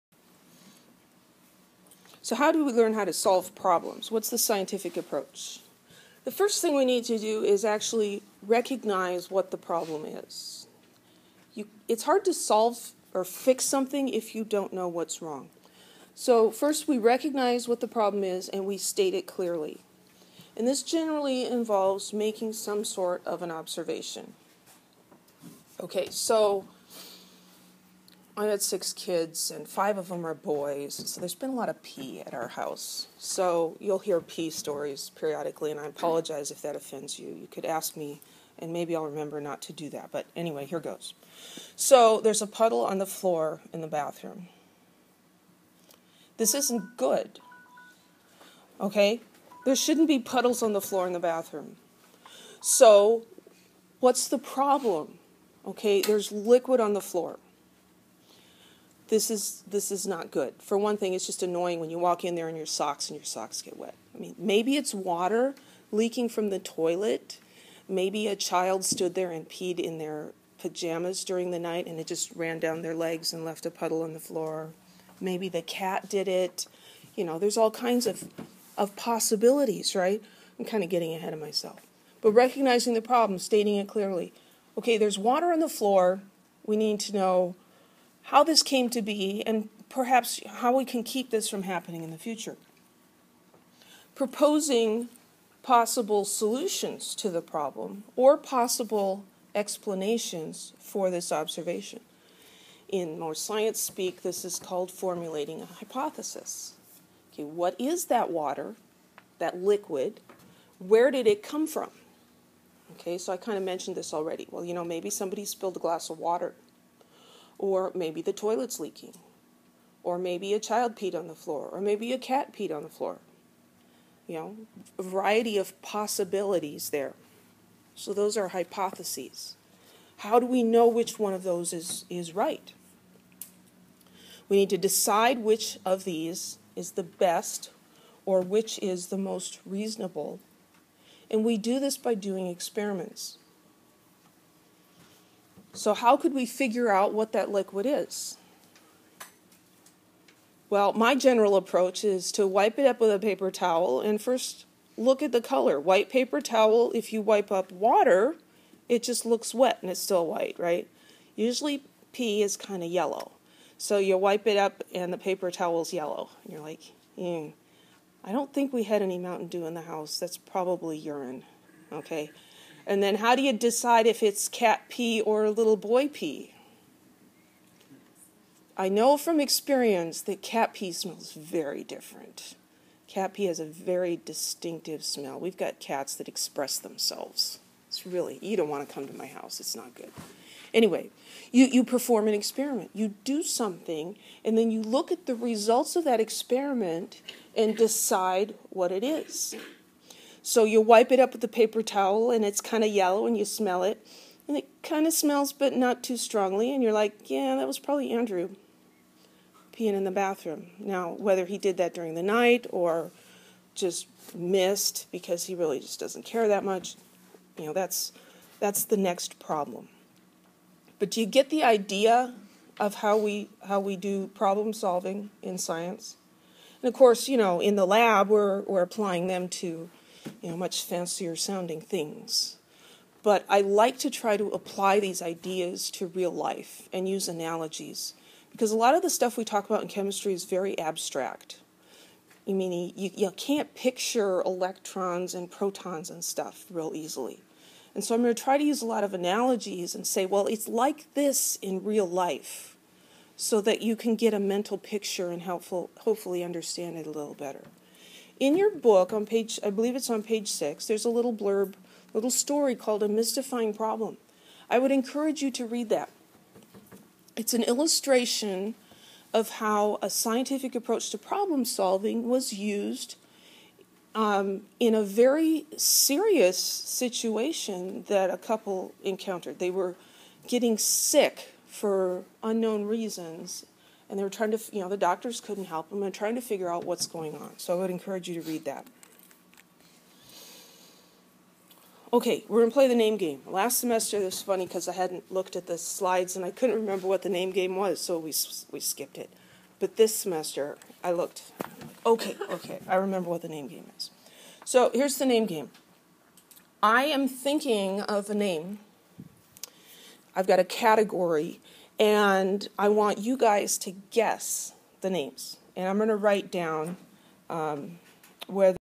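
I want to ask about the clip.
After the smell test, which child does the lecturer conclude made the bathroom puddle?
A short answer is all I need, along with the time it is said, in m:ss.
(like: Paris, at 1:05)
Andrew, at 3:28.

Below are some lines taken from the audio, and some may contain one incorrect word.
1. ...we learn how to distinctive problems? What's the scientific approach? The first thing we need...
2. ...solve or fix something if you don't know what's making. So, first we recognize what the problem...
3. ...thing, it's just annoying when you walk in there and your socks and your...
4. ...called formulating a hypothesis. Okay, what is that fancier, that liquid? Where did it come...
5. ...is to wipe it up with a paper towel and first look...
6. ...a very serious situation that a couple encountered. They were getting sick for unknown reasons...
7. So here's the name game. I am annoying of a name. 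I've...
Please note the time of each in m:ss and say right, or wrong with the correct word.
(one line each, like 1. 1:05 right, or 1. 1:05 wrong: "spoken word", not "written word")
1. 0:02 wrong: "solve", not "distinctive"
2. 0:12 wrong: "wrong", not "making"
3. 1:00 right
4. 1:44 wrong: "water", not "fancier"
5. 2:32 right
6. 4:34 right
7. 5:04 wrong: "thinking", not "annoying".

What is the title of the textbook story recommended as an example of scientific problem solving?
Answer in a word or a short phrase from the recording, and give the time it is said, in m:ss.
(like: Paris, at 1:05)
A Mystifying Problem, at 4:23.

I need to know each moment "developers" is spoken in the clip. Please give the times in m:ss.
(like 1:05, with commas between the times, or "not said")
not said.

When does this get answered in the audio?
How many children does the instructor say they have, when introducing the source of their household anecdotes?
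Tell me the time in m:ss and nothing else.
0:28.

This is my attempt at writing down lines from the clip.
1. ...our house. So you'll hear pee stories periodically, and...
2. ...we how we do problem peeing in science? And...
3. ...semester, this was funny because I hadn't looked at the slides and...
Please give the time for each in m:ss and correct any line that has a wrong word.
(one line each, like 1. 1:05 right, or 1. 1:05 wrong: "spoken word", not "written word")
1. 0:32 right
2. 3:43 wrong: "solving", not "peeing"
3. 4:53 right.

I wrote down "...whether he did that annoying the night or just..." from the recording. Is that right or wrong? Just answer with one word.
wrong.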